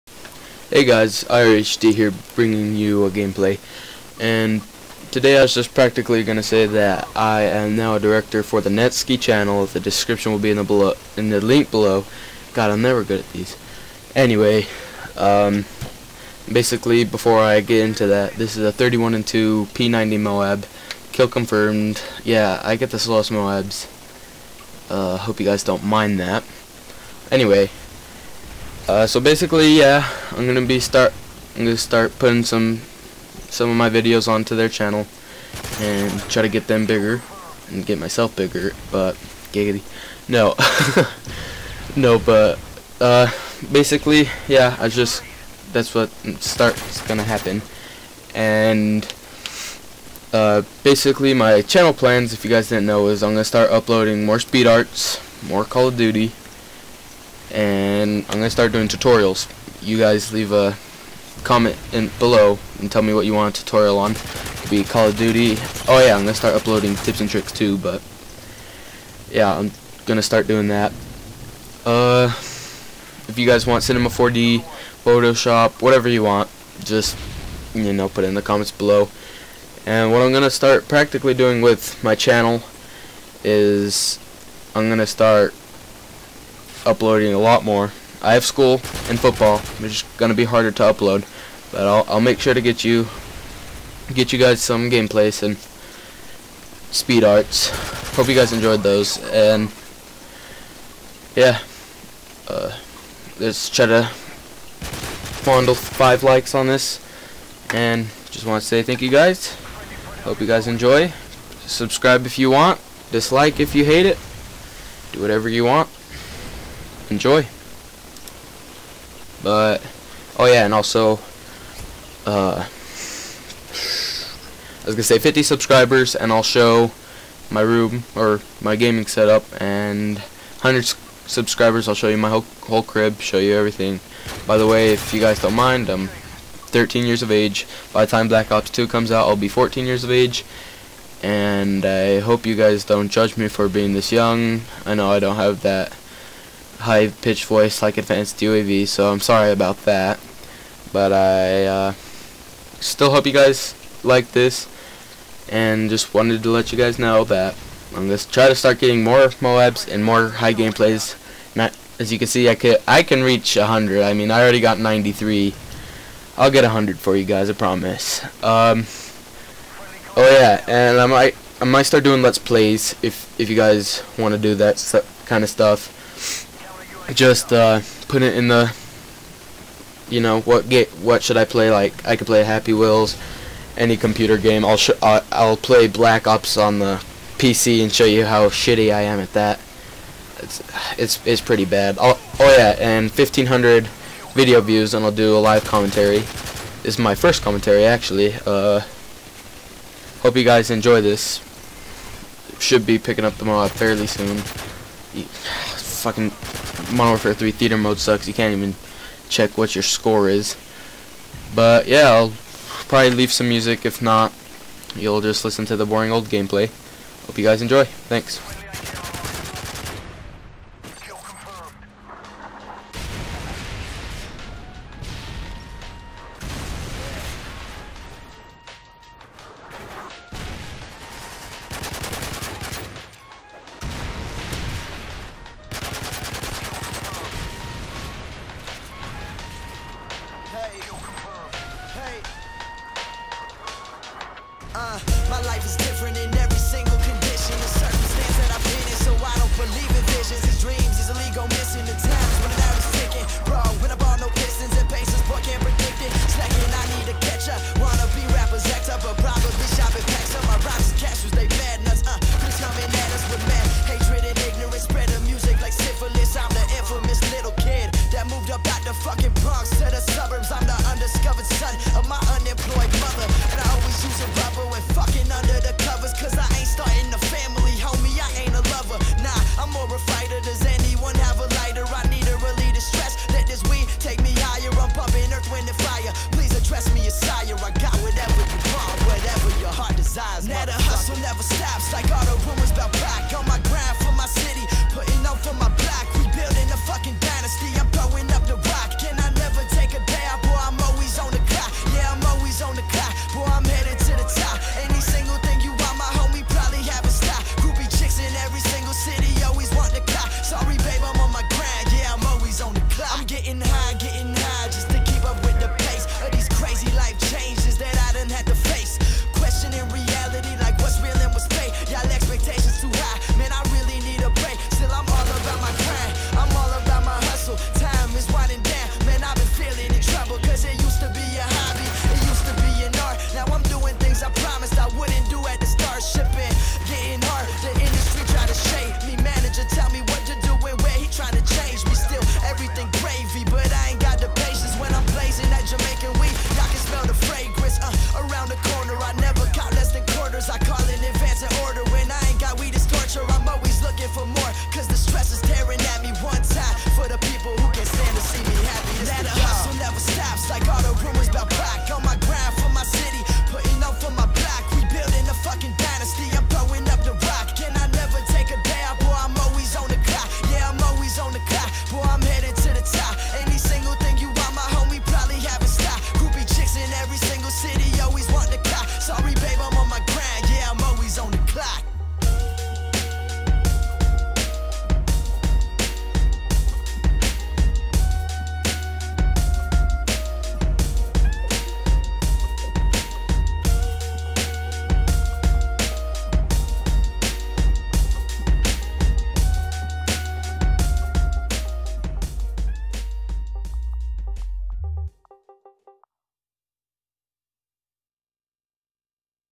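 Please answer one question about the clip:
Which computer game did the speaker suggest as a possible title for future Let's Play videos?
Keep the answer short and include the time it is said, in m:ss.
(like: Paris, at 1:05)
Happy Wheels, at 3:02.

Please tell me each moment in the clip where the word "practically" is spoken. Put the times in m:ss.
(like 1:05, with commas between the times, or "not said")
0:05, 1:20.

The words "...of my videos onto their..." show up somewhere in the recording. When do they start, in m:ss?
0:33.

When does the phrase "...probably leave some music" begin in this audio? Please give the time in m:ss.
3:32.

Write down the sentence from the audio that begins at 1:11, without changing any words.
Uh, if you guys want Cinema 4D, Photoshop, whatever you want, just you know, put it in the comments below.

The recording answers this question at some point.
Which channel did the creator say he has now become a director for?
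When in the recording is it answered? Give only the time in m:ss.
0:08.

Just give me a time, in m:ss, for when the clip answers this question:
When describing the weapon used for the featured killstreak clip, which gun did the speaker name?
0:19.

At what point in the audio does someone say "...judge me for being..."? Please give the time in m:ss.
2:23.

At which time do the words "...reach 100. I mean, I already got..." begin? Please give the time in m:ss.
2:43.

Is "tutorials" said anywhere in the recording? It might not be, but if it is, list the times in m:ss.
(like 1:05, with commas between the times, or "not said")
0:58, 1:03.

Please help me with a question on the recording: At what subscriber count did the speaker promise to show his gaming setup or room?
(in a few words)
50.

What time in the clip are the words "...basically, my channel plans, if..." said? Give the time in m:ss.
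0:50.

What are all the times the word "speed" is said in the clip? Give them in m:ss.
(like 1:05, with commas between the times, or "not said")
0:54, 1:36.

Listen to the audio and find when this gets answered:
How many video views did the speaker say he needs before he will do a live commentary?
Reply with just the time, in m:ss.
3:13.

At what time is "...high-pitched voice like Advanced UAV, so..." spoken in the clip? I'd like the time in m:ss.
2:26.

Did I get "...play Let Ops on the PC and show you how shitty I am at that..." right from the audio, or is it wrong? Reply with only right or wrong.
wrong.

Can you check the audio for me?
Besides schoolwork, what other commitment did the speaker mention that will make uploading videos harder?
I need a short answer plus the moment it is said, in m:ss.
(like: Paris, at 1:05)
football, at 1:29.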